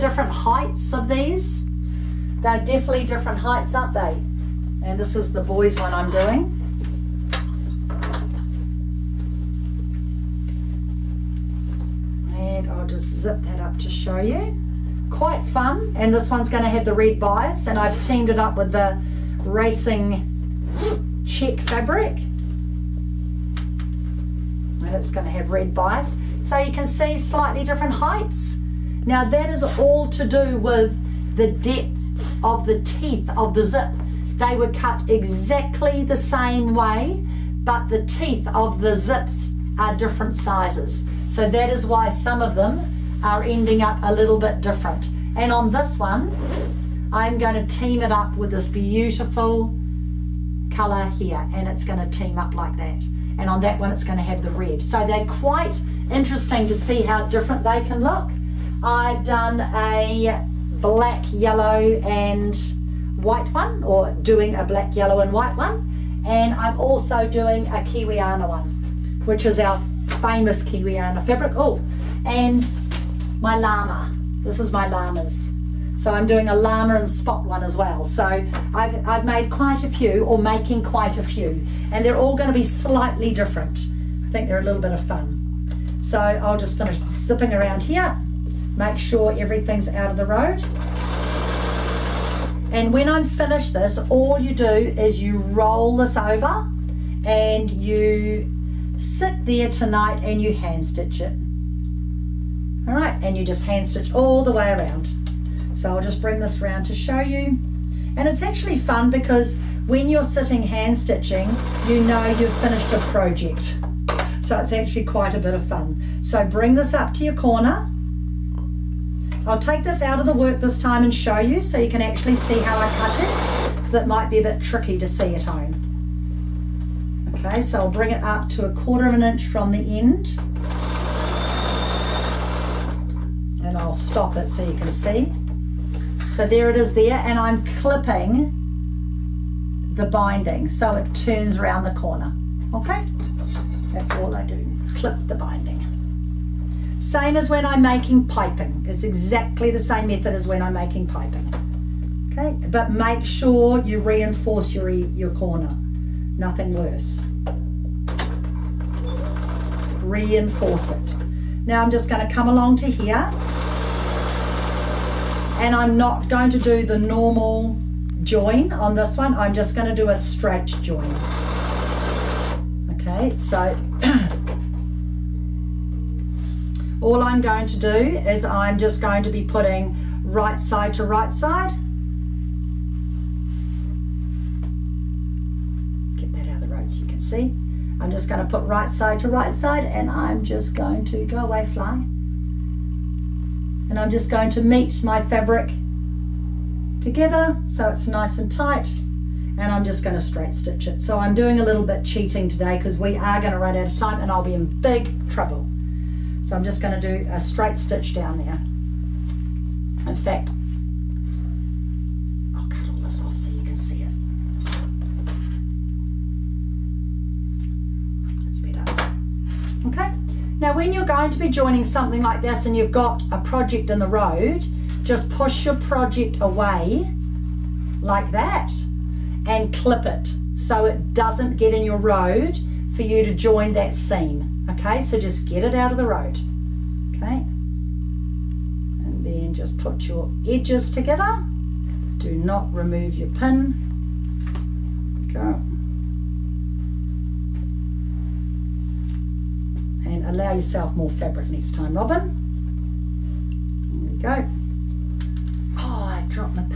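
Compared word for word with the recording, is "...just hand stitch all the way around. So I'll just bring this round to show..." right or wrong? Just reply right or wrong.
right.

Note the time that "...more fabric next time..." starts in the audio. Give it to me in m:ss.
4:10.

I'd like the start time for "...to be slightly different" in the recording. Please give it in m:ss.
1:22.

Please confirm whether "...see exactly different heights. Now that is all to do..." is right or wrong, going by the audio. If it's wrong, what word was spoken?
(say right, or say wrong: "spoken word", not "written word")
wrong: "slightly", not "exactly".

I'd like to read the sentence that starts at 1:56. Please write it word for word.
So bring this up to your corner.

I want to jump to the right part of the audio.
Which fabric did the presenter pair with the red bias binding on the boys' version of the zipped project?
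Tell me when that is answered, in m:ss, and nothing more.
0:19.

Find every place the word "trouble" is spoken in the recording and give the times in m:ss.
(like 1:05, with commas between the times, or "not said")
3:25.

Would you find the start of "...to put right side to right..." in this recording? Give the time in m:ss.
3:08.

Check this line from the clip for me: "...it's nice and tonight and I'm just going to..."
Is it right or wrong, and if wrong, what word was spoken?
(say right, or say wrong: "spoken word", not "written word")
wrong: "tight", not "tonight".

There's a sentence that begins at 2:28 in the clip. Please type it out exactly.
It's exactly the same method as when I'm making piping.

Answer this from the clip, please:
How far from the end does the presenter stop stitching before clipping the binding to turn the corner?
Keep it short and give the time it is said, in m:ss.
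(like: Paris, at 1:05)
a quarter of an inch, at 2:08.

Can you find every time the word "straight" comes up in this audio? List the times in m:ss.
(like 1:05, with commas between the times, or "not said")
2:50, 3:20, 3:27.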